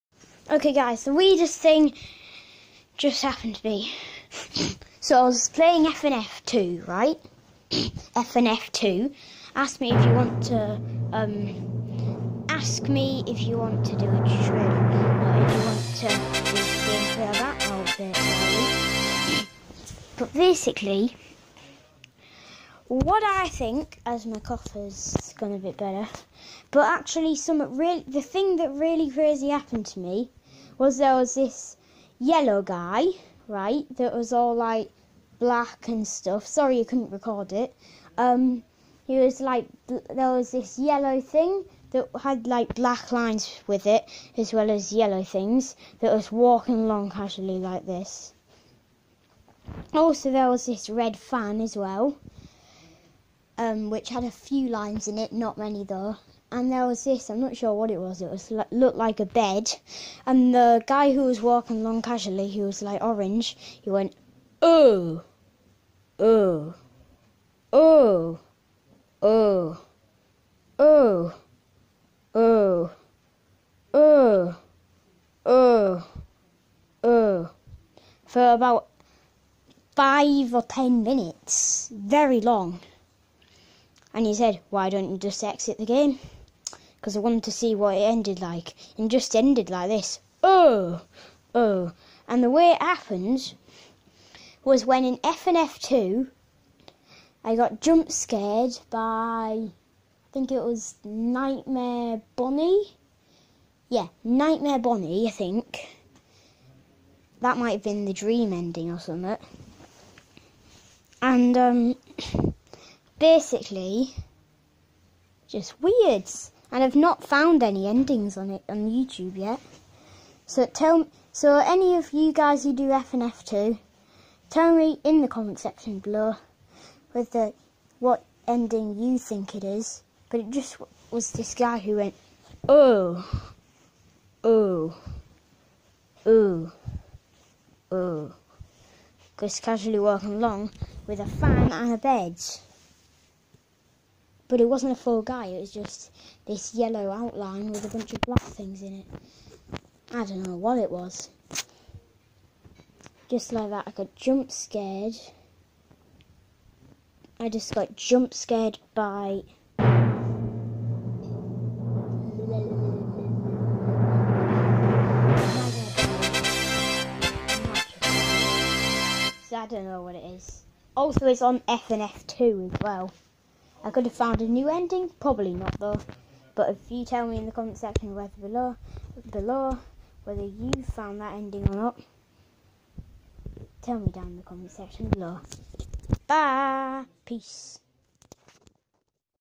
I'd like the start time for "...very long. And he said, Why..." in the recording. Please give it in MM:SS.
01:21.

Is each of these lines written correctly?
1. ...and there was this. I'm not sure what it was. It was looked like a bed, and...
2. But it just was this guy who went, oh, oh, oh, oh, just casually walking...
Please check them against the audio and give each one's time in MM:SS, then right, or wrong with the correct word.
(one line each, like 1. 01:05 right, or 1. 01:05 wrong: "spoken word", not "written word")
1. 00:56 right
2. 02:10 right.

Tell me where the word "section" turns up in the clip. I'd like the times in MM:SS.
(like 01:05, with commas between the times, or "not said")
02:05, 02:57, 03:04.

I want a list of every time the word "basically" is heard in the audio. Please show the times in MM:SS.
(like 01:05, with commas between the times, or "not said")
00:20, 01:53.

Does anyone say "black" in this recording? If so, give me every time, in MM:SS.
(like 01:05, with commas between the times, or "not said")
00:35, 00:42, 02:28.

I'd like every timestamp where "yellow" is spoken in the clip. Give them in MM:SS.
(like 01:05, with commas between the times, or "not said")
00:32, 00:40, 00:44, 02:26.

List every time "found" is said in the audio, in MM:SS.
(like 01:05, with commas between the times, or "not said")
01:57, 02:54, 03:00.